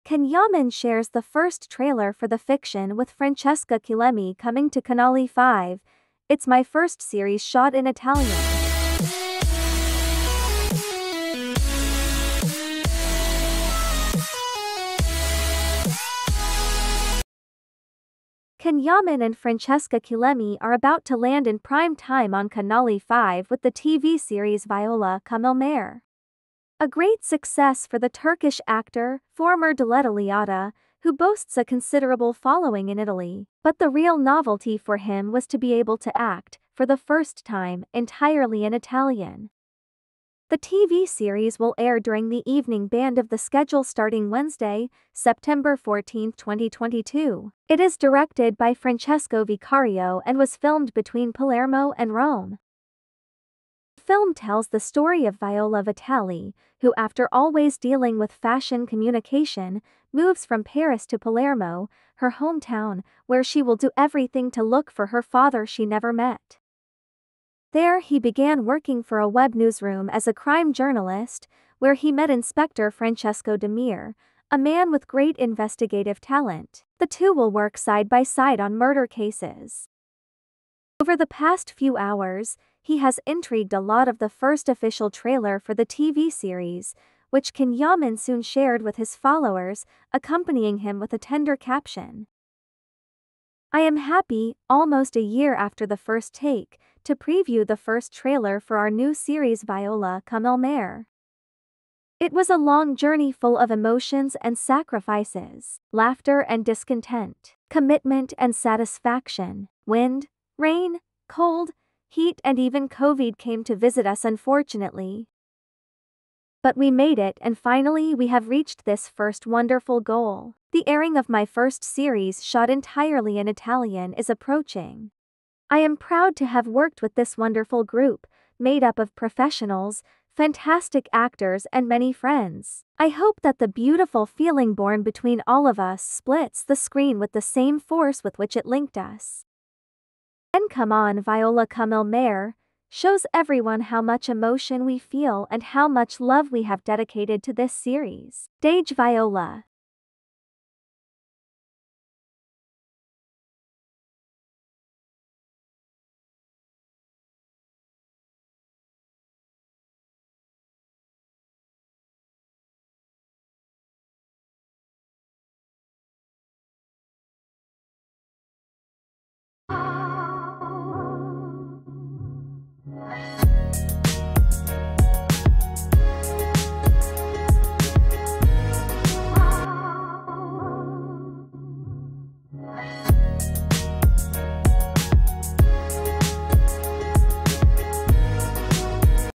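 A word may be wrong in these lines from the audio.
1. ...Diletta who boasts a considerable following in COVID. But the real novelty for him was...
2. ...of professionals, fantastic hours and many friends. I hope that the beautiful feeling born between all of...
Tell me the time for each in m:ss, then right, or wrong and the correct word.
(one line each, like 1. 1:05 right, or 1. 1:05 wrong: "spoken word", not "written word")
1. 0:29 wrong: "Italy", not "COVID"
2. 2:08 wrong: "actors", not "hours".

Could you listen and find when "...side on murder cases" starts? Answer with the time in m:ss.
1:18.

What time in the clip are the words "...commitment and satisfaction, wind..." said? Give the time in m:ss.
1:47.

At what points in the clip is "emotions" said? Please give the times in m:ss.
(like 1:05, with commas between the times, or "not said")
1:43, 2:24.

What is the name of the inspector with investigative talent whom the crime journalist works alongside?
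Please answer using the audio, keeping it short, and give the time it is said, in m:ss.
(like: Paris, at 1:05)
Francesco Demir, at 1:12.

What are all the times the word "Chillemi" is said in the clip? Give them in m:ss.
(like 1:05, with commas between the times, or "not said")
0:03, 0:19.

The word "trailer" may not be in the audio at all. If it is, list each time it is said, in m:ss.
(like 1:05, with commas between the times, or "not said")
0:01, 1:25, 1:38.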